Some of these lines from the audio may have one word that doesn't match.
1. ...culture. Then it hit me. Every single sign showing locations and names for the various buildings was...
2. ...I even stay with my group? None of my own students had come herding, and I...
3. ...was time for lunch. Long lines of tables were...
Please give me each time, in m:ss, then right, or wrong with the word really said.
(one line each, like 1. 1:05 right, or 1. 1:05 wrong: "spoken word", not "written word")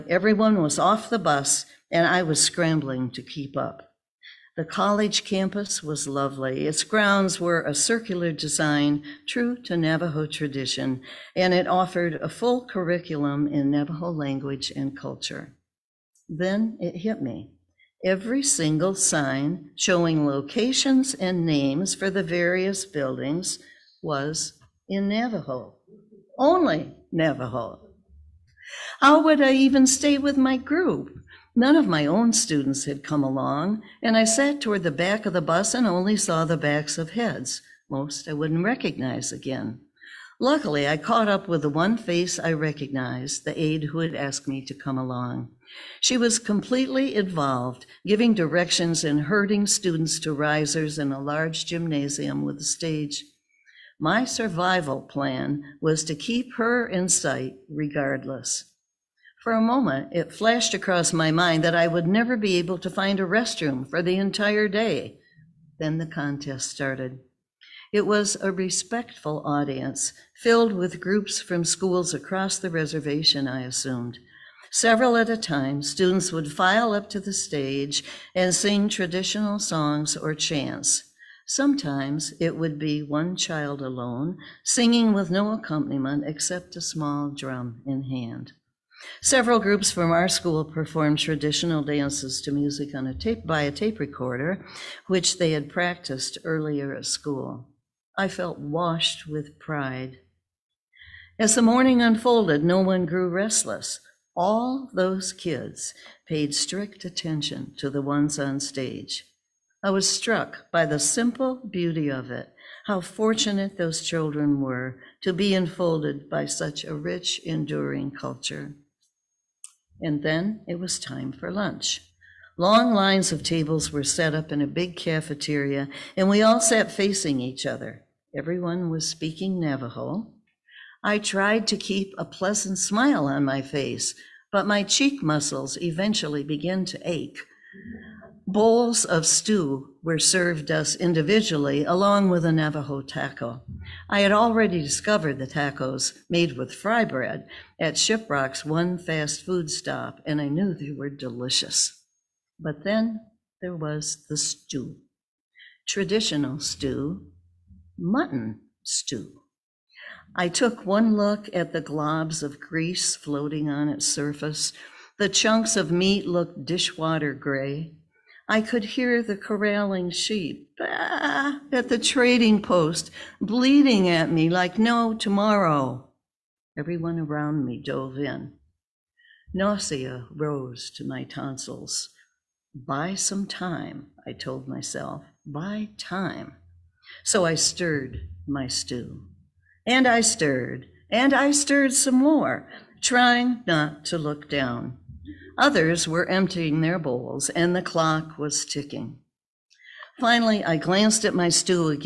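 1. 0:14 right
2. 0:29 wrong: "along", not "herding"
3. 2:00 right.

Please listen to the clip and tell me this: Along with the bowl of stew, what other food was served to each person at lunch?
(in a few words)
Navajo taco.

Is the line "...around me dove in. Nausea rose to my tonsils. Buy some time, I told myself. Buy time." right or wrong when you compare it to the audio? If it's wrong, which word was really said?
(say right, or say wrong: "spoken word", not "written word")
right.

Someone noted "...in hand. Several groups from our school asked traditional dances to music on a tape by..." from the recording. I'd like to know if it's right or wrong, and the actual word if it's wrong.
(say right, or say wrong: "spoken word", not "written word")
wrong: "performed", not "asked".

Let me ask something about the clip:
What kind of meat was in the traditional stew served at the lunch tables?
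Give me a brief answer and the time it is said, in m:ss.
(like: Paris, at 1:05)
Mutton, at 2:37.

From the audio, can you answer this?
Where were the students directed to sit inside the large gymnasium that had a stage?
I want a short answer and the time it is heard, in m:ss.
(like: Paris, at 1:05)
Risers, at 0:50.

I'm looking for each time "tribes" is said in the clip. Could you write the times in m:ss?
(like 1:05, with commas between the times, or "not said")
not said.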